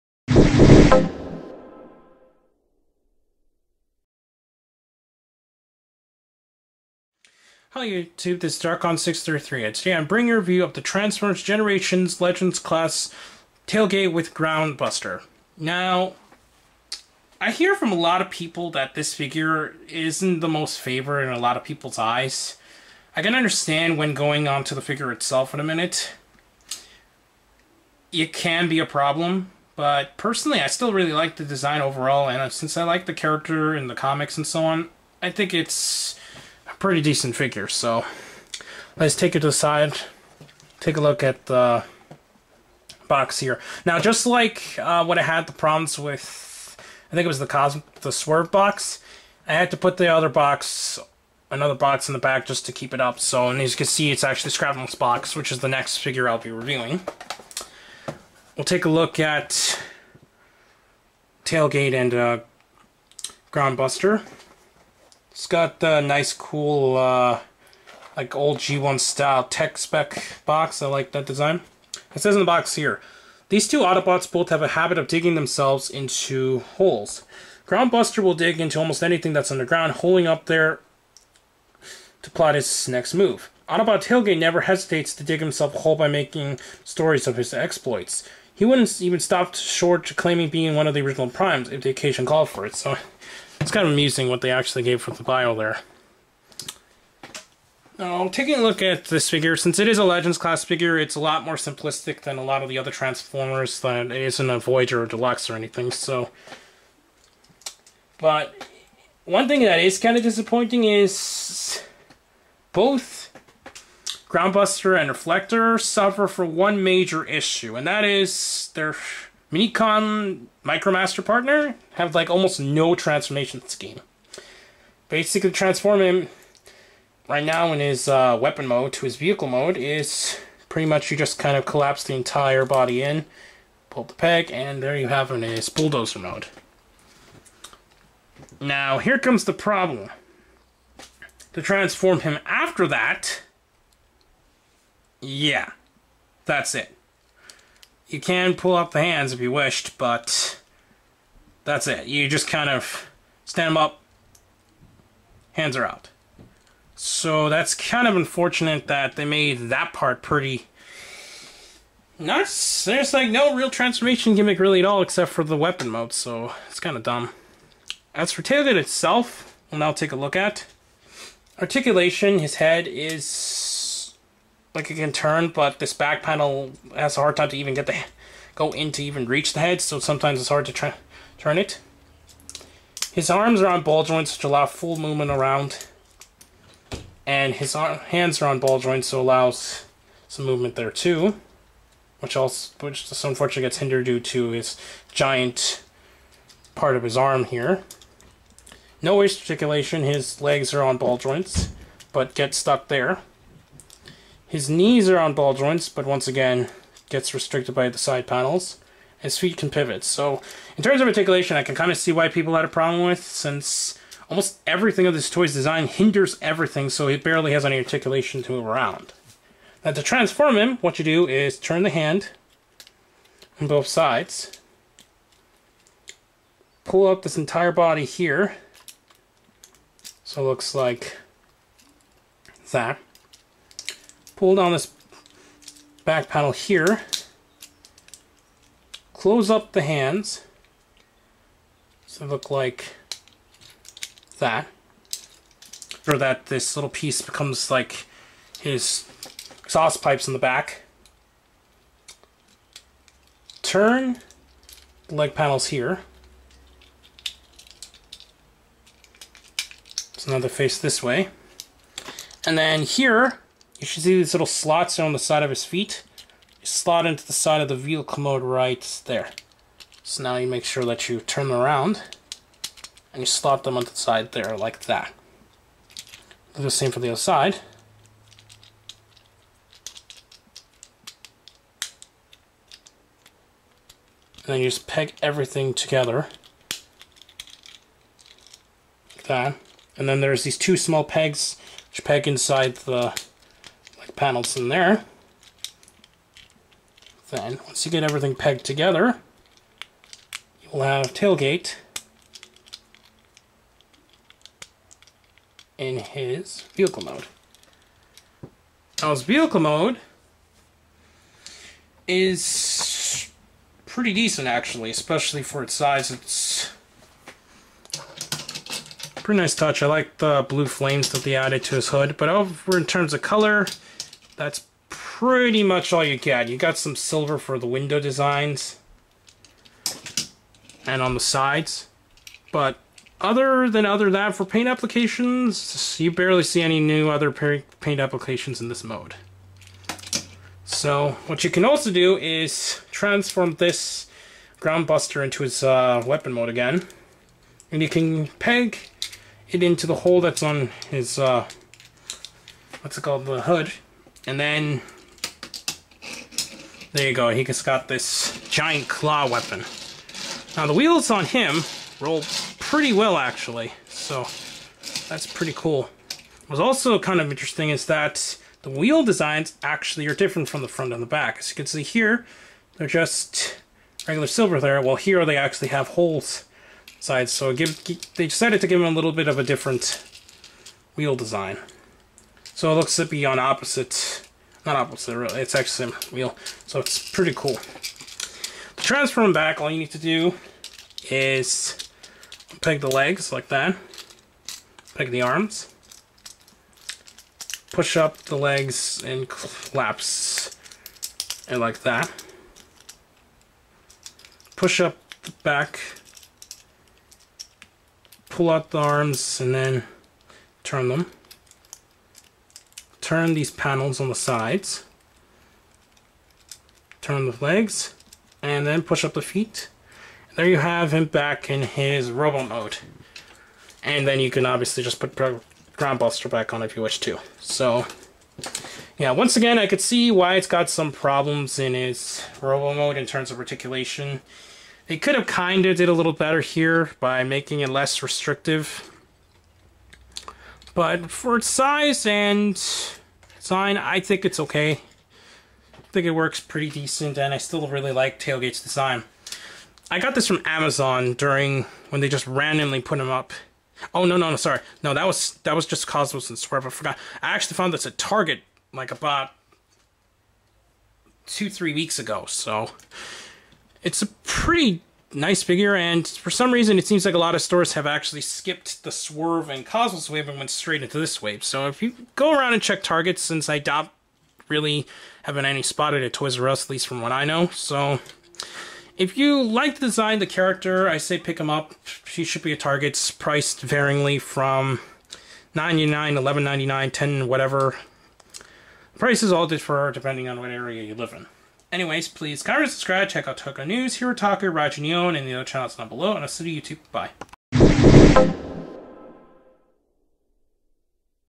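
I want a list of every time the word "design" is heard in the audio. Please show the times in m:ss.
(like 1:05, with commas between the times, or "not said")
0:31, 1:11, 3:35, 5:27, 6:09, 6:21, 7:28, 7:59.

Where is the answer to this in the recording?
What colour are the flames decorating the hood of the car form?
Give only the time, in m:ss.
5:20.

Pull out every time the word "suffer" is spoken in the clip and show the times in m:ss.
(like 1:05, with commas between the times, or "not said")
1:55.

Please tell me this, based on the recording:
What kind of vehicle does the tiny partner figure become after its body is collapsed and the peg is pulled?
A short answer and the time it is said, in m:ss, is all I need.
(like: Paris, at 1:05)
bulldozer, at 2:15.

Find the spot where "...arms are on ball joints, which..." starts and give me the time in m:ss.
3:03.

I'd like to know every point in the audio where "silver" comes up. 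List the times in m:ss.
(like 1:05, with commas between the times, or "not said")
5:26, 6:14.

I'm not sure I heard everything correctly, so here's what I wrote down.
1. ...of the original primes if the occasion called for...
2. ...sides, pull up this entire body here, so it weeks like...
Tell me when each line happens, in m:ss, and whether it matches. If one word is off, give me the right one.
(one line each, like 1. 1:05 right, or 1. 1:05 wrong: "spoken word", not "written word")
1. 1:30 right
2. 3:43 wrong: "looks", not "weeks".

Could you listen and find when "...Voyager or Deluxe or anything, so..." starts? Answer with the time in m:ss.
1:44.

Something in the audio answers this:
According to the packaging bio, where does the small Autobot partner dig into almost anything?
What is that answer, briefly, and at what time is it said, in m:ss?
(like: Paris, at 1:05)
underground, at 1:19.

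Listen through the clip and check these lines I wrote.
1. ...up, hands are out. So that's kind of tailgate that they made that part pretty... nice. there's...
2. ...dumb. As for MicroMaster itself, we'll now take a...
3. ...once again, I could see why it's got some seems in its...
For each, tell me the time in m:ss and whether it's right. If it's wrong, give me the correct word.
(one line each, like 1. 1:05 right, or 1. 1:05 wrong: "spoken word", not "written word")
1. 2:33 wrong: "unfortunate", not "tailgate"
2. 2:47 wrong: "Tailgate", not "MicroMaster"
3. 7:09 wrong: "problems", not "seems".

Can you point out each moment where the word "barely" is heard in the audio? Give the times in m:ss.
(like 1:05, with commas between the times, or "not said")
3:37, 5:36.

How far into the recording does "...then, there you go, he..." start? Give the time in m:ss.
5:54.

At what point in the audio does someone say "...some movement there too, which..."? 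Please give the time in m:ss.
3:10.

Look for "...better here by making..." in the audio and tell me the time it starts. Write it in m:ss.
7:16.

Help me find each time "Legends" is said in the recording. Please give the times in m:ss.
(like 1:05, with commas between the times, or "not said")
0:12, 1:40.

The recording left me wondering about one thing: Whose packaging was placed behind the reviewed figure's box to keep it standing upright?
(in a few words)
Shrapnel.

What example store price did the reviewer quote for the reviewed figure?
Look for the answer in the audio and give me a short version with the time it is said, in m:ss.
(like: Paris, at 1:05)
$11.99, at 8:06.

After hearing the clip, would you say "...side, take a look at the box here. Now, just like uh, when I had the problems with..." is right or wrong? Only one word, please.
right.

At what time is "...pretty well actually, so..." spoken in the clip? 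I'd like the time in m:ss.
6:02.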